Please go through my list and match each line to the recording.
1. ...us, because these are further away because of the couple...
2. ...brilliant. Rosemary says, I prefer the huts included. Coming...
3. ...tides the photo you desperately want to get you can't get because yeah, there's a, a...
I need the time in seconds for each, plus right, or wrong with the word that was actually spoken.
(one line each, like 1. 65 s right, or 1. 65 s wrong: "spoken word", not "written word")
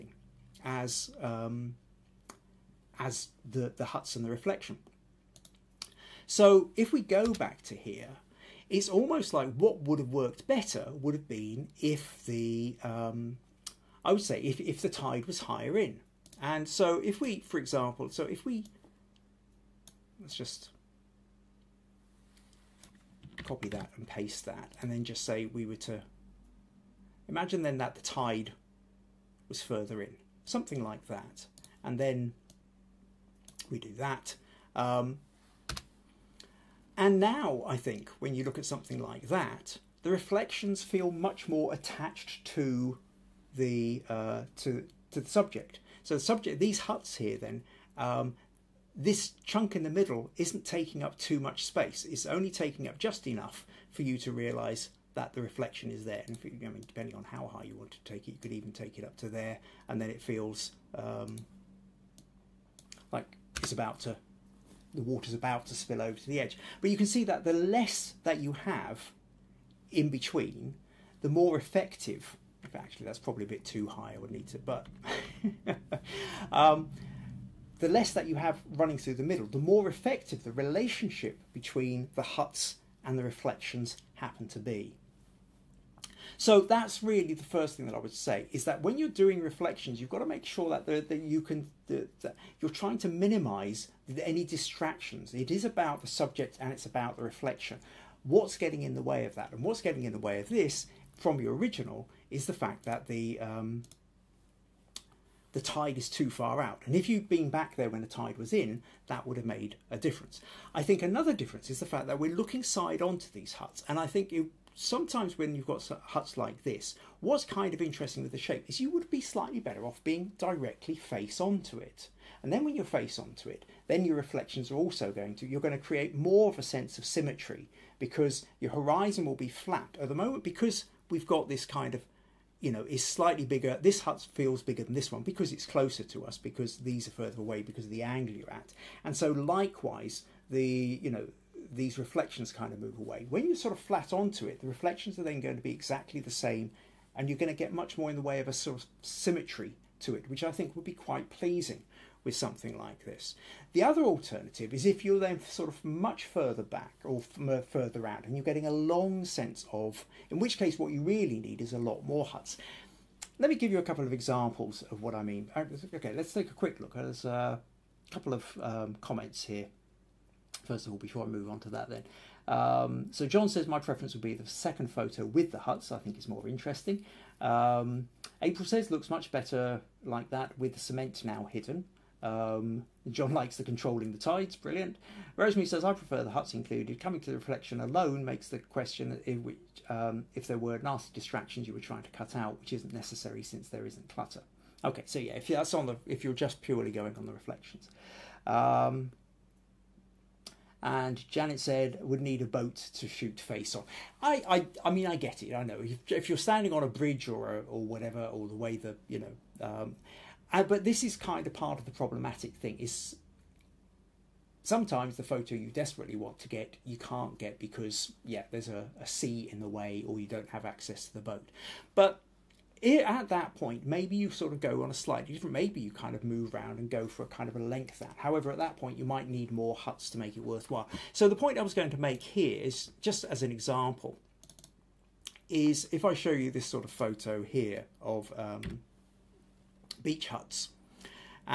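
1. 136 s wrong: "angle", not "couple"
2. 184 s right
3. 214 s wrong: "sometimes", not "tides".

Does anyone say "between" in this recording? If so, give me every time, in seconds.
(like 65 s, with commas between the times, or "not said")
70 s, 81 s.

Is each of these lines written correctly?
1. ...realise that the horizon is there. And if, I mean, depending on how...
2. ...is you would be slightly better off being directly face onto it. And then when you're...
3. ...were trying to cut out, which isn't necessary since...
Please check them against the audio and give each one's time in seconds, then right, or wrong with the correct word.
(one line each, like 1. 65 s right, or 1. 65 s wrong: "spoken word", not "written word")
1. 54 s wrong: "reflection", not "horizon"
2. 118 s right
3. 191 s right.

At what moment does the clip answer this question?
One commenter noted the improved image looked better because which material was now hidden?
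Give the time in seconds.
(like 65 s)
180 s.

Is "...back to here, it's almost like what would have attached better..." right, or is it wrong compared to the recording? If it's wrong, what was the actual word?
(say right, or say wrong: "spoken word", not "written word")
wrong: "worked", not "attached".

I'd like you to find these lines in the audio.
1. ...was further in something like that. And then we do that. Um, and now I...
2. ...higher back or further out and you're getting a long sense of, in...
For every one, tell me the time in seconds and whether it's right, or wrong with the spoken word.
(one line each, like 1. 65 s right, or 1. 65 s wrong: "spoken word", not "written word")
1. 29 s right
2. 156 s wrong: "further", not "higher".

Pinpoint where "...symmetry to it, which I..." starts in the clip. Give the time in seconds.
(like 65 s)
149 s.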